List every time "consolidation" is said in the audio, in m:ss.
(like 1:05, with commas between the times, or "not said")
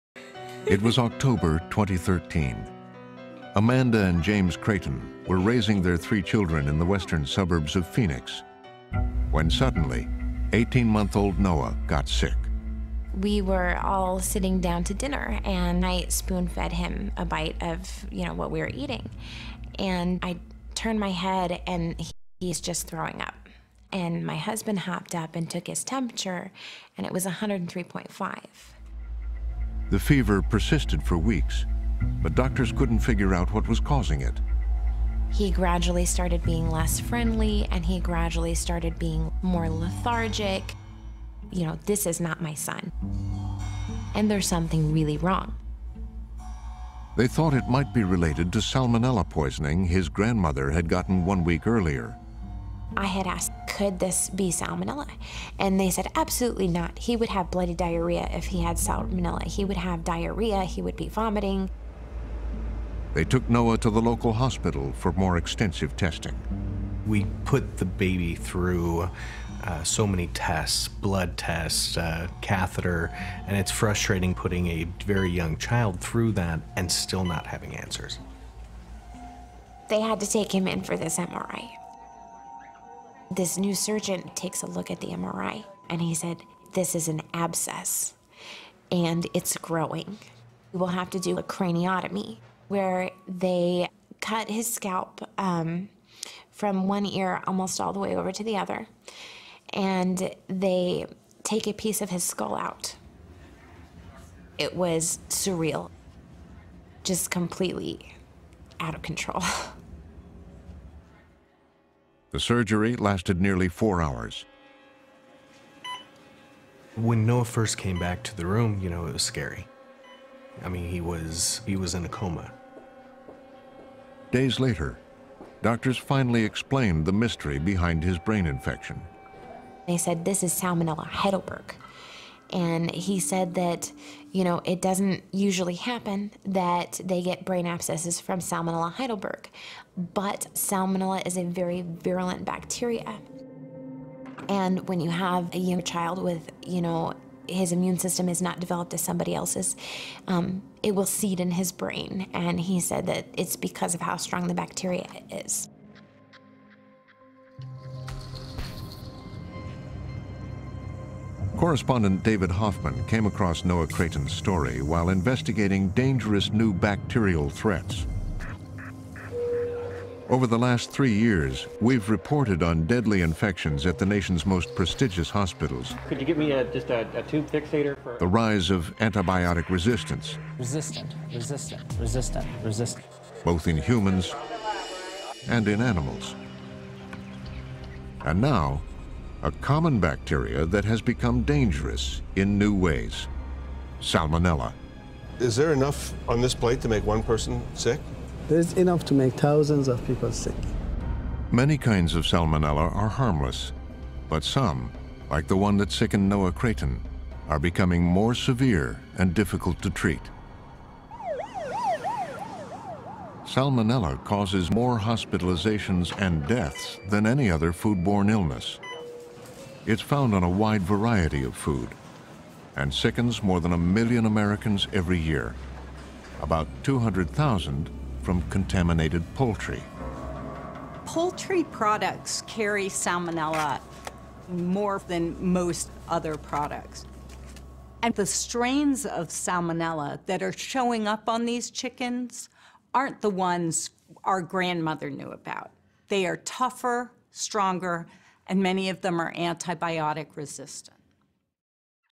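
not said.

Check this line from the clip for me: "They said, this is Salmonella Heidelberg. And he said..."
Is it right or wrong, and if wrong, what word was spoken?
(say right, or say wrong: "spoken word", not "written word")
right.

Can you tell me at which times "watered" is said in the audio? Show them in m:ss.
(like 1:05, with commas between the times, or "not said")
not said.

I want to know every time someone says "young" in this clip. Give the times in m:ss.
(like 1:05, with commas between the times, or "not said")
1:15, 2:25.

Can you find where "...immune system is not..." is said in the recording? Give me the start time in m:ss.
2:27.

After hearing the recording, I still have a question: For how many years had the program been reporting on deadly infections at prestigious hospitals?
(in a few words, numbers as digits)
3 years.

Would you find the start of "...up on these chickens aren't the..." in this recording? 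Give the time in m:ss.
4:01.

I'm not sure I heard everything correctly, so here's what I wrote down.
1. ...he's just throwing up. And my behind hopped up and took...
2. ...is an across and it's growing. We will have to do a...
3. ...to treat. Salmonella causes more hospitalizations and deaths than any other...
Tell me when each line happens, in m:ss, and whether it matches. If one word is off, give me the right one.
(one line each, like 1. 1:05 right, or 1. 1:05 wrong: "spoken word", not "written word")
1. 0:22 wrong: "husband", not "behind"
2. 1:26 wrong: "abscess", not "across"
3. 3:29 right.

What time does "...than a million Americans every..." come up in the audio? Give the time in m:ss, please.
3:43.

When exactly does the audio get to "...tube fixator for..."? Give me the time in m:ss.
2:57.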